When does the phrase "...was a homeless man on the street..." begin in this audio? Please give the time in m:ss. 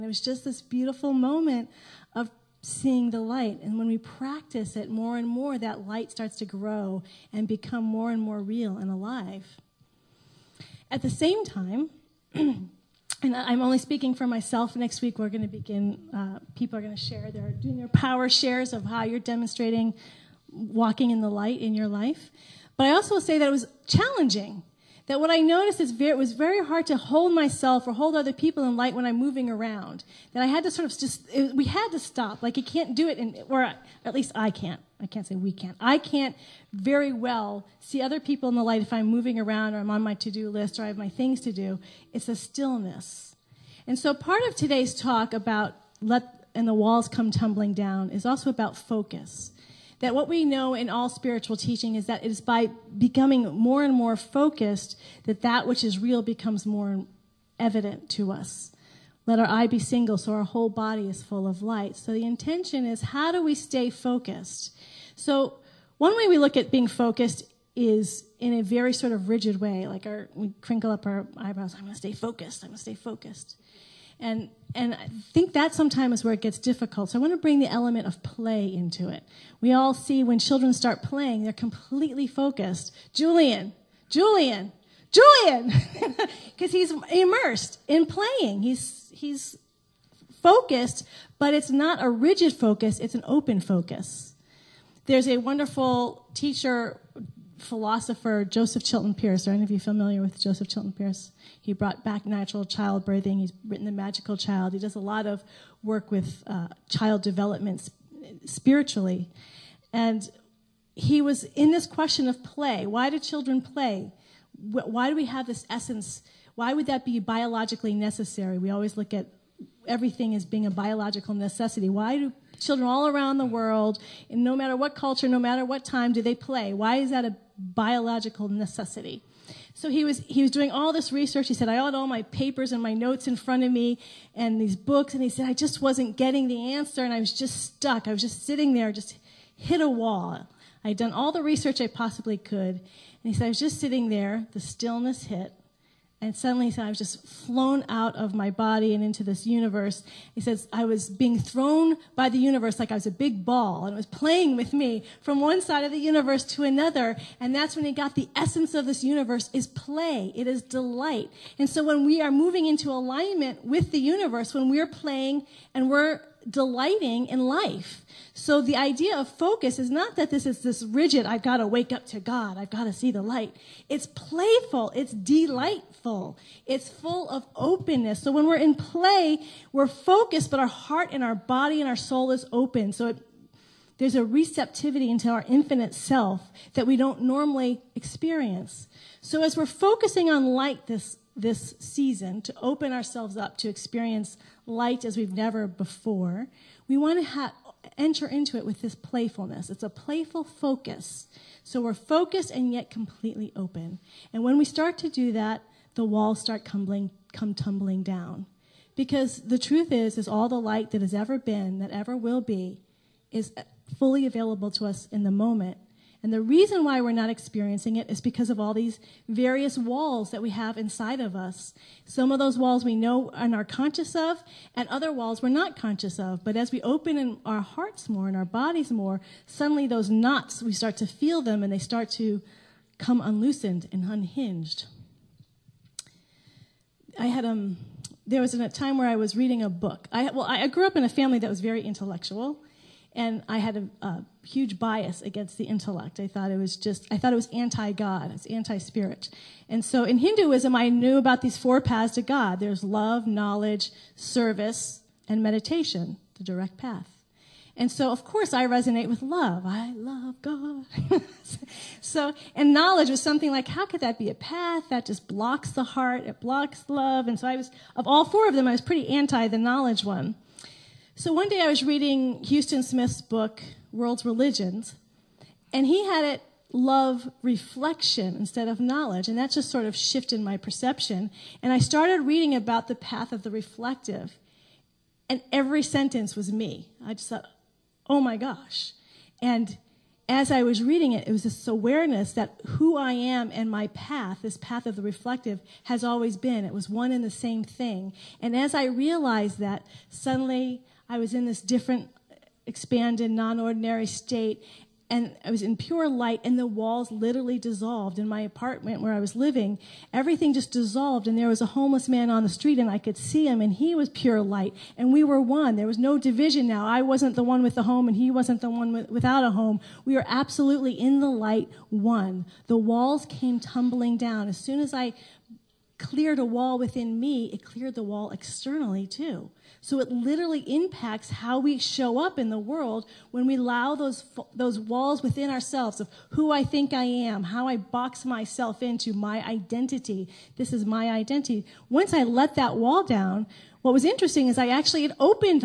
5:11.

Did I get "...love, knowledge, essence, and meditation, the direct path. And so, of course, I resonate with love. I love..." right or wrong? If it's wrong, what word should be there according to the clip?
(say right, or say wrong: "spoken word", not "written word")
wrong: "service", not "essence".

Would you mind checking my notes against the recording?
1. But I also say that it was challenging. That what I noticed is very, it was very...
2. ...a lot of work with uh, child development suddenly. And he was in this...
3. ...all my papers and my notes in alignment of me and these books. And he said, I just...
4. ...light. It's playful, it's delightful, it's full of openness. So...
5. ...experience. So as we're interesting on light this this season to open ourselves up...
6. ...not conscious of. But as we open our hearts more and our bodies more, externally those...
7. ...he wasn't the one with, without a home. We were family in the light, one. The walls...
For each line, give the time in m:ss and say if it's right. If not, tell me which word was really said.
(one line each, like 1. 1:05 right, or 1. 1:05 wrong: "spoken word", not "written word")
1. 0:22 right
2. 1:44 wrong: "spiritually", not "suddenly"
3. 2:11 wrong: "front", not "alignment"
4. 2:53 right
5. 3:07 wrong: "focusing", not "interesting"
6. 3:45 wrong: "suddenly", not "externally"
7. 5:18 wrong: "absolutely", not "family".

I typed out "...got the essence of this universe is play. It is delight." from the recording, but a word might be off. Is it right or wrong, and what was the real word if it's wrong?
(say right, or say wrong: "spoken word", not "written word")
right.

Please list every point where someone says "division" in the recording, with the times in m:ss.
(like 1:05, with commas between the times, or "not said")
5:16.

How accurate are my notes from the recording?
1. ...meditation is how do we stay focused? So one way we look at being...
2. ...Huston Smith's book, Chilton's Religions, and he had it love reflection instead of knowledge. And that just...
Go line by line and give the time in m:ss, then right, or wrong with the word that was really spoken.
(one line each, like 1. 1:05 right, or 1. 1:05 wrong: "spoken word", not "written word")
1. 1:02 wrong: "intention", not "meditation"
2. 4:32 wrong: "World", not "Chilton".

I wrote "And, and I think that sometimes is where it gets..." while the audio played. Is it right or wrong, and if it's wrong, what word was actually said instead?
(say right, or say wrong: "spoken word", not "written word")
right.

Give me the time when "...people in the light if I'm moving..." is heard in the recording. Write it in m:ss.
0:38.